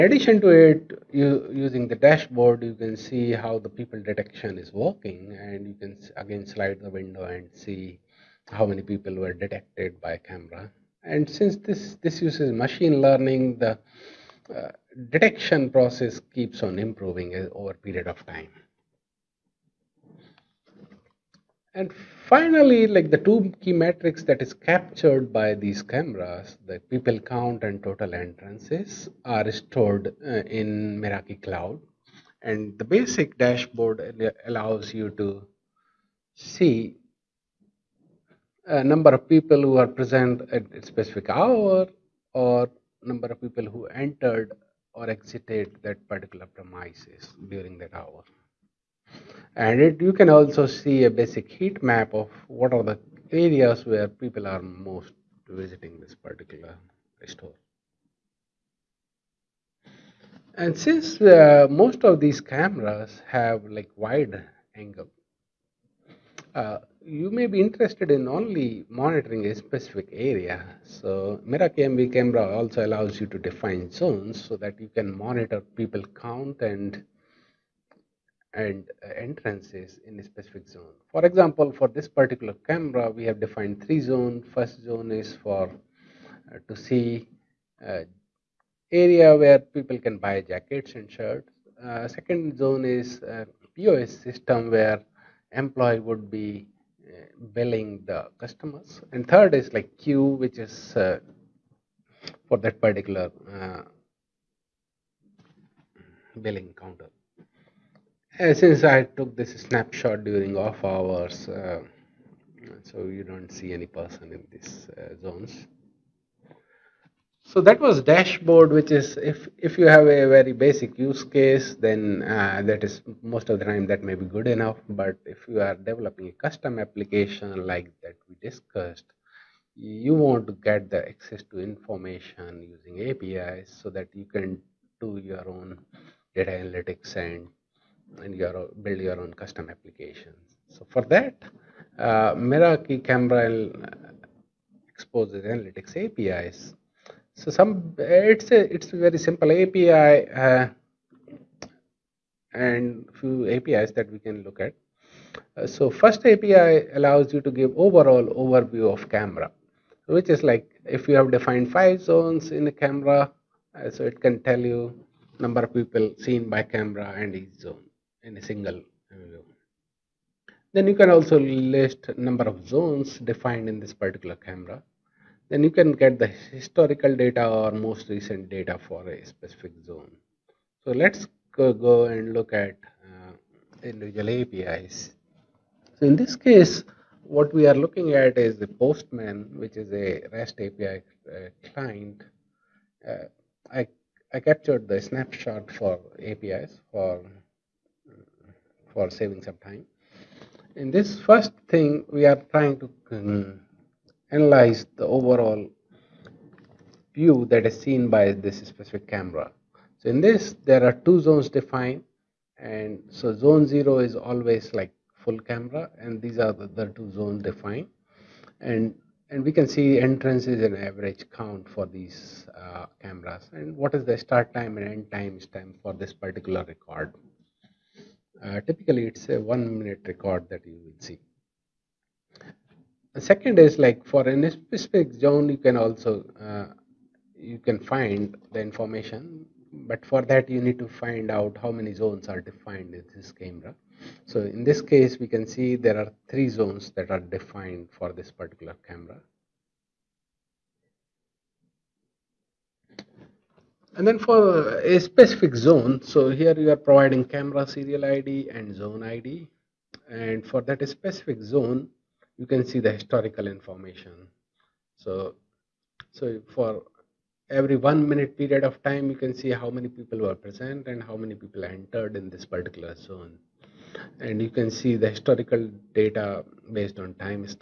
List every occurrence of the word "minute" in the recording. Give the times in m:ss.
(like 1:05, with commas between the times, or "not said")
3:49, 4:28.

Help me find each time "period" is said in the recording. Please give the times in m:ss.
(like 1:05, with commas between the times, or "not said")
0:17, 4:28.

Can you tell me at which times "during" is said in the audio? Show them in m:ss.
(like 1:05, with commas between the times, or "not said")
0:47, 1:50.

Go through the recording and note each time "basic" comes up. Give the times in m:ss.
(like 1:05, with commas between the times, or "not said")
0:32, 0:51, 2:00.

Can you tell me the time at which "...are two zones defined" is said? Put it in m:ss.
3:30.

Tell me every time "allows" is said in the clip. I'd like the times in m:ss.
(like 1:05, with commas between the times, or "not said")
0:34, 1:12, 2:36.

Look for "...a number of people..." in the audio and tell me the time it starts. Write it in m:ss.
0:38.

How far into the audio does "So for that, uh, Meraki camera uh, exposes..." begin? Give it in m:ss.
2:20.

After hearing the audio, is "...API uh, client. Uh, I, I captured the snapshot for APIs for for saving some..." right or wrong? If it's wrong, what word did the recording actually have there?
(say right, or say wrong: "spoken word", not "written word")
right.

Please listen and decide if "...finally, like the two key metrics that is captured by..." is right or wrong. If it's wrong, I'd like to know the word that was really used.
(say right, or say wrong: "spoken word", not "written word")
right.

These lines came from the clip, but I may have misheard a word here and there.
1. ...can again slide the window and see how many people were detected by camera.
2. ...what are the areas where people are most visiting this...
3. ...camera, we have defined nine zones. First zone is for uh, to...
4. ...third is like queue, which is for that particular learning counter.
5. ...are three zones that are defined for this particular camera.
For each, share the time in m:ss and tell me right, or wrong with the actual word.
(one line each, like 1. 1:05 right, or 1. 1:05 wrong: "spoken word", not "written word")
1. 0:05 right
2. 0:52 right
3. 1:22 wrong: "three", not "nine"
4. 1:39 wrong: "billing", not "learning"
5. 4:05 right.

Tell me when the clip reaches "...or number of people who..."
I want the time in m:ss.
0:42.